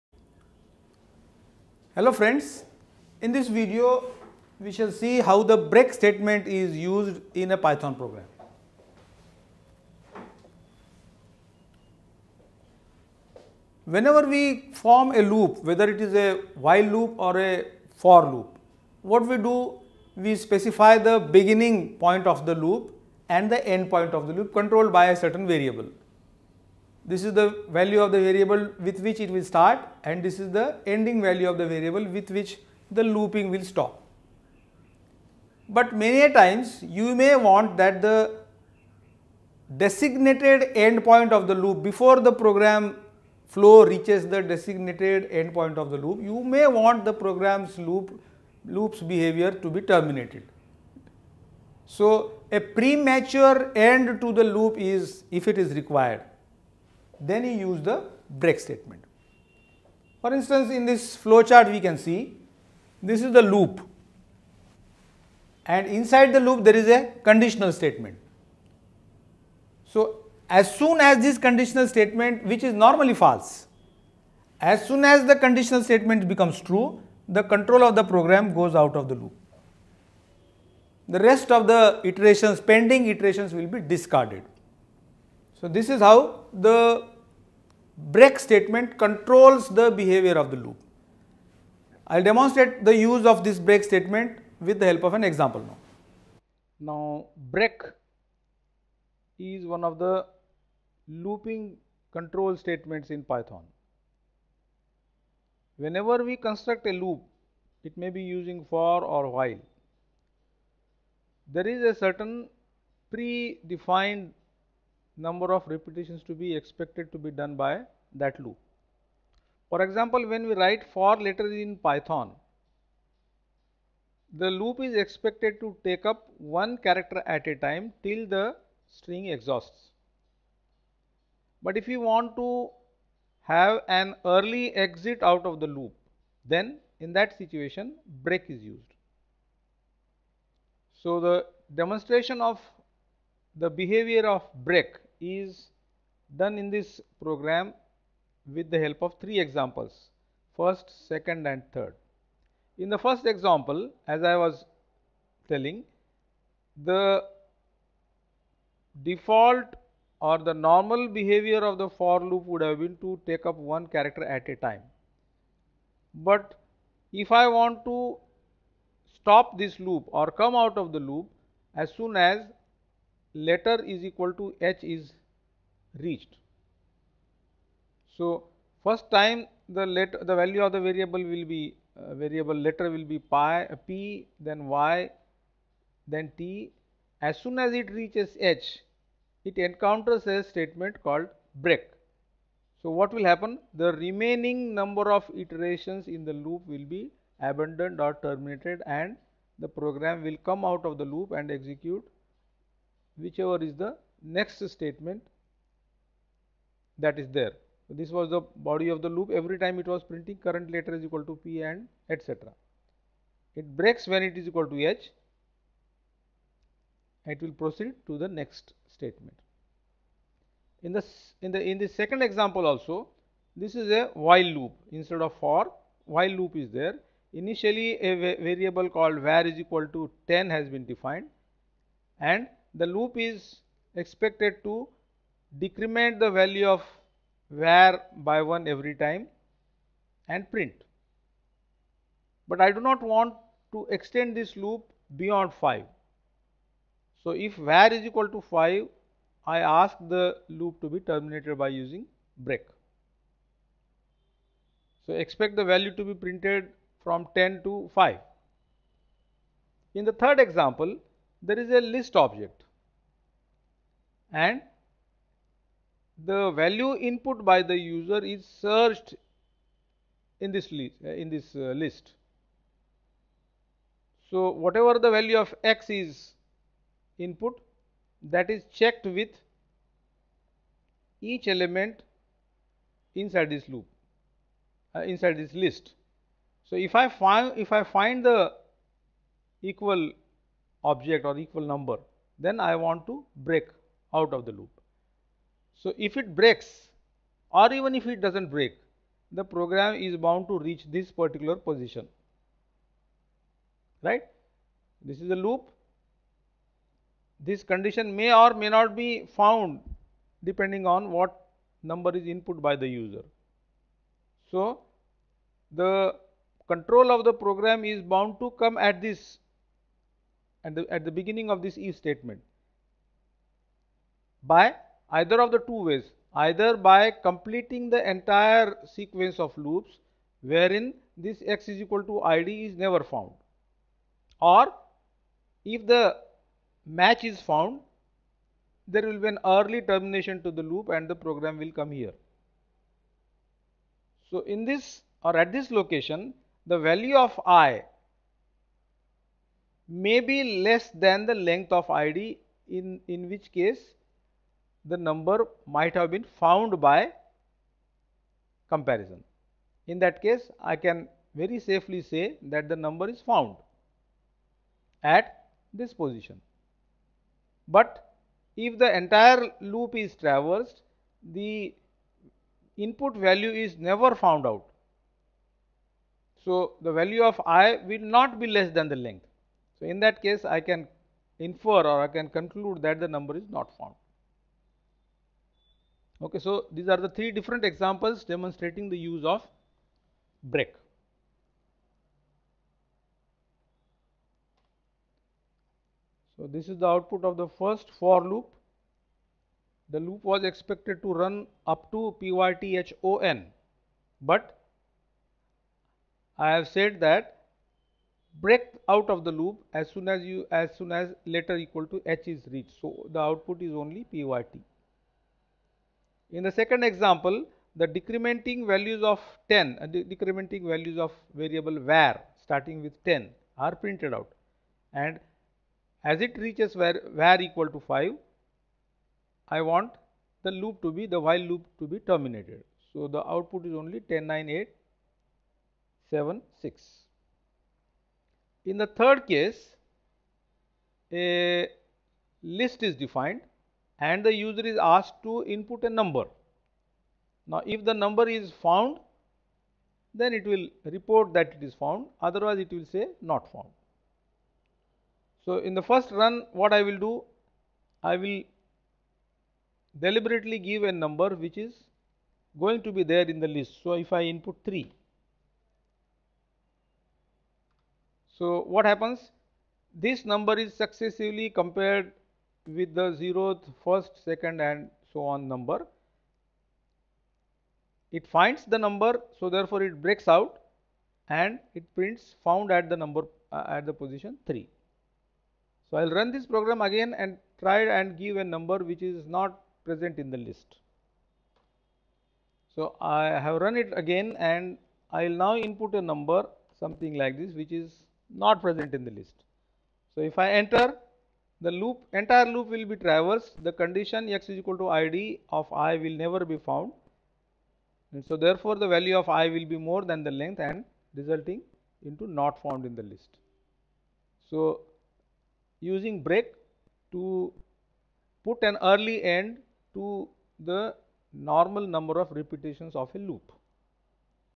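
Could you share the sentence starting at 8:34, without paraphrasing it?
So using break to put an early end to the normal number of repetitions of a loop.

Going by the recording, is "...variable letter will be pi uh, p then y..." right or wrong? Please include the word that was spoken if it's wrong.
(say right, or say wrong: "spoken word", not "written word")
right.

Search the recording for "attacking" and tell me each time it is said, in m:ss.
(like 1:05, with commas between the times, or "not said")
not said.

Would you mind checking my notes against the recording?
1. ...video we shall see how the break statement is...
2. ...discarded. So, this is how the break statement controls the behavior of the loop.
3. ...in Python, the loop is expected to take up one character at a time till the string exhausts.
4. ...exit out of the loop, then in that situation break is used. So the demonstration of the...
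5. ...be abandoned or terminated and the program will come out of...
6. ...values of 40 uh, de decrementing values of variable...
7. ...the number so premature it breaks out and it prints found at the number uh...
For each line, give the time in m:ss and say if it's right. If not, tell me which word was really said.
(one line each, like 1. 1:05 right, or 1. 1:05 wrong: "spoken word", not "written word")
1. 0:03 right
2. 1:23 right
3. 2:01 right
4. 2:14 right
5. 3:16 right
6. 6:58 wrong: "10", not "40"
7. 7:58 wrong: "therefore", not "premature".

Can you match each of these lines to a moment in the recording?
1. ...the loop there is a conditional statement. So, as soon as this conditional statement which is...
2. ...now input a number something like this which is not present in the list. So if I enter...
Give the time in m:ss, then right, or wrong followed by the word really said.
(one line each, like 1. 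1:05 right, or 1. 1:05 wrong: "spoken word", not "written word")
1. 1:06 right
2. 8:15 right.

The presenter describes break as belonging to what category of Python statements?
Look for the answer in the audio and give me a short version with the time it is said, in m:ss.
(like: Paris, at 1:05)
looping control statements, at 1:41.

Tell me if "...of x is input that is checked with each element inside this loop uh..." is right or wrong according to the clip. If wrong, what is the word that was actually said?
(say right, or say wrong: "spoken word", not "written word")
right.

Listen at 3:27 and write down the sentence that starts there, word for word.
So, this was the body of the loop every time it was printing current letter is equal to P and etc.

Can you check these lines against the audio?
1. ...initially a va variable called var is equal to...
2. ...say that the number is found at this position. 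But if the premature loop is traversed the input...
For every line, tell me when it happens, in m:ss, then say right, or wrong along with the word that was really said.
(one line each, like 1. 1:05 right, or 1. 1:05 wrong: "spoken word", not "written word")
1. 3:47 right
2. 6:02 wrong: "entire", not "premature".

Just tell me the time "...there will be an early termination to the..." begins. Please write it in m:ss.
5:38.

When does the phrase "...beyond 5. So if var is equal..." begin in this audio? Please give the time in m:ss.
4:05.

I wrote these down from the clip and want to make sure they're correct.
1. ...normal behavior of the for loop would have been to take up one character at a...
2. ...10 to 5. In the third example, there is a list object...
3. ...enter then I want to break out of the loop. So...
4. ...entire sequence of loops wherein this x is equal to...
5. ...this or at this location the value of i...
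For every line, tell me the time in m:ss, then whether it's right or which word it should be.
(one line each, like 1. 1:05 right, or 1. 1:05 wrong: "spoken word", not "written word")
1. 2:40 right
2. 4:17 right
3. 4:51 wrong: "number", not "enter"
4. 5:28 right
5. 5:44 right.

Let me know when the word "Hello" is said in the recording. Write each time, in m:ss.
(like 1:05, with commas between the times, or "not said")
0:01.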